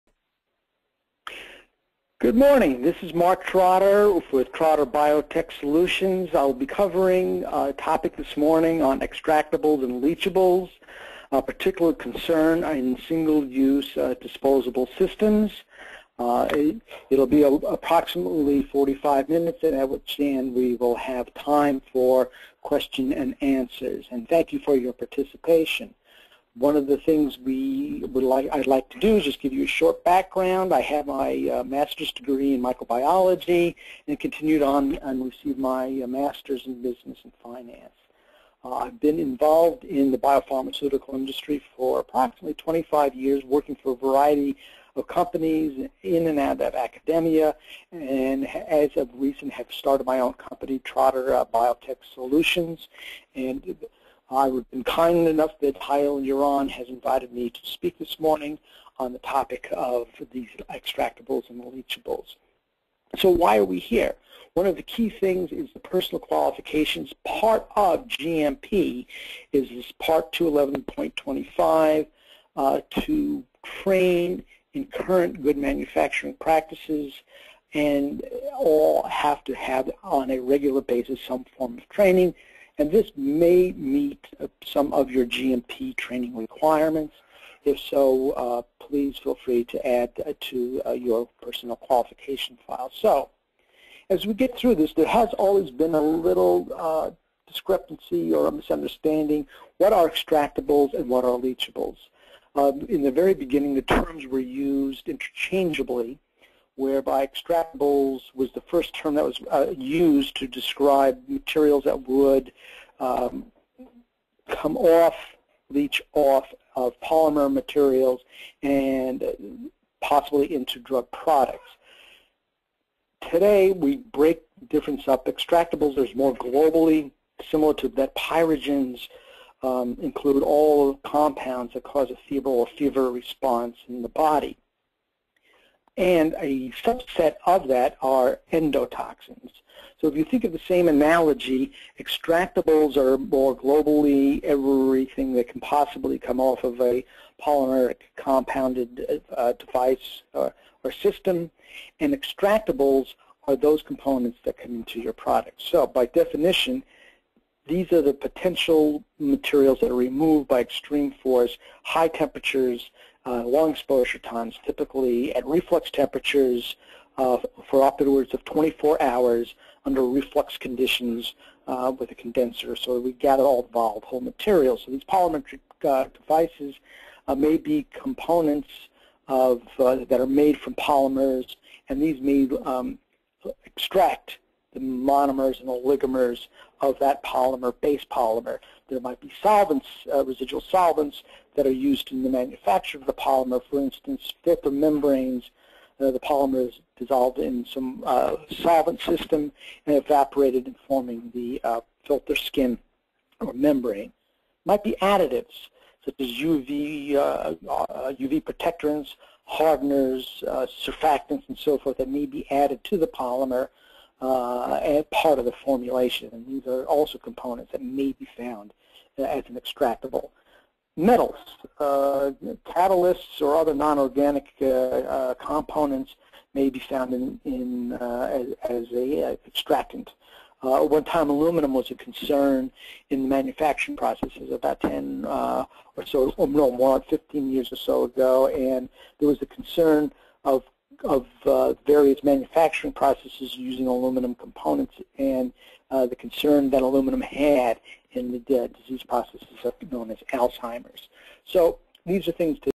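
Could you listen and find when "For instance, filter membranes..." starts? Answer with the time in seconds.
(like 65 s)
193 s.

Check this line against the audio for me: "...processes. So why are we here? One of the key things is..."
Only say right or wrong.
wrong.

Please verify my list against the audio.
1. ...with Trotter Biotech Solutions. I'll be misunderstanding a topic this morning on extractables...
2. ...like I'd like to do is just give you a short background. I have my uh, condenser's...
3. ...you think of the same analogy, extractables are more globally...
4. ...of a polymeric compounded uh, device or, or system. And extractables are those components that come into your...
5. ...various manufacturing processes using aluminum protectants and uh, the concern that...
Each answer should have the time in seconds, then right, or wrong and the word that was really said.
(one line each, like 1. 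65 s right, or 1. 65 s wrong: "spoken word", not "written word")
1. 4 s wrong: "covering", not "misunderstanding"
2. 28 s wrong: "master", not "condenser"
3. 140 s right
4. 146 s right
5. 241 s wrong: "components", not "protectants".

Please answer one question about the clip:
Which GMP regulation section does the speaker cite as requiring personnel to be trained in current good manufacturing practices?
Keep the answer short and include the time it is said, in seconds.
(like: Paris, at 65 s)
Part 211.25, at 69 s.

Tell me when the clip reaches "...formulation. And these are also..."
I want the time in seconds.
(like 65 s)
215 s.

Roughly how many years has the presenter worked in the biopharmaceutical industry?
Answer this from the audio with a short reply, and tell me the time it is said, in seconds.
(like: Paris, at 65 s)
25 years, at 42 s.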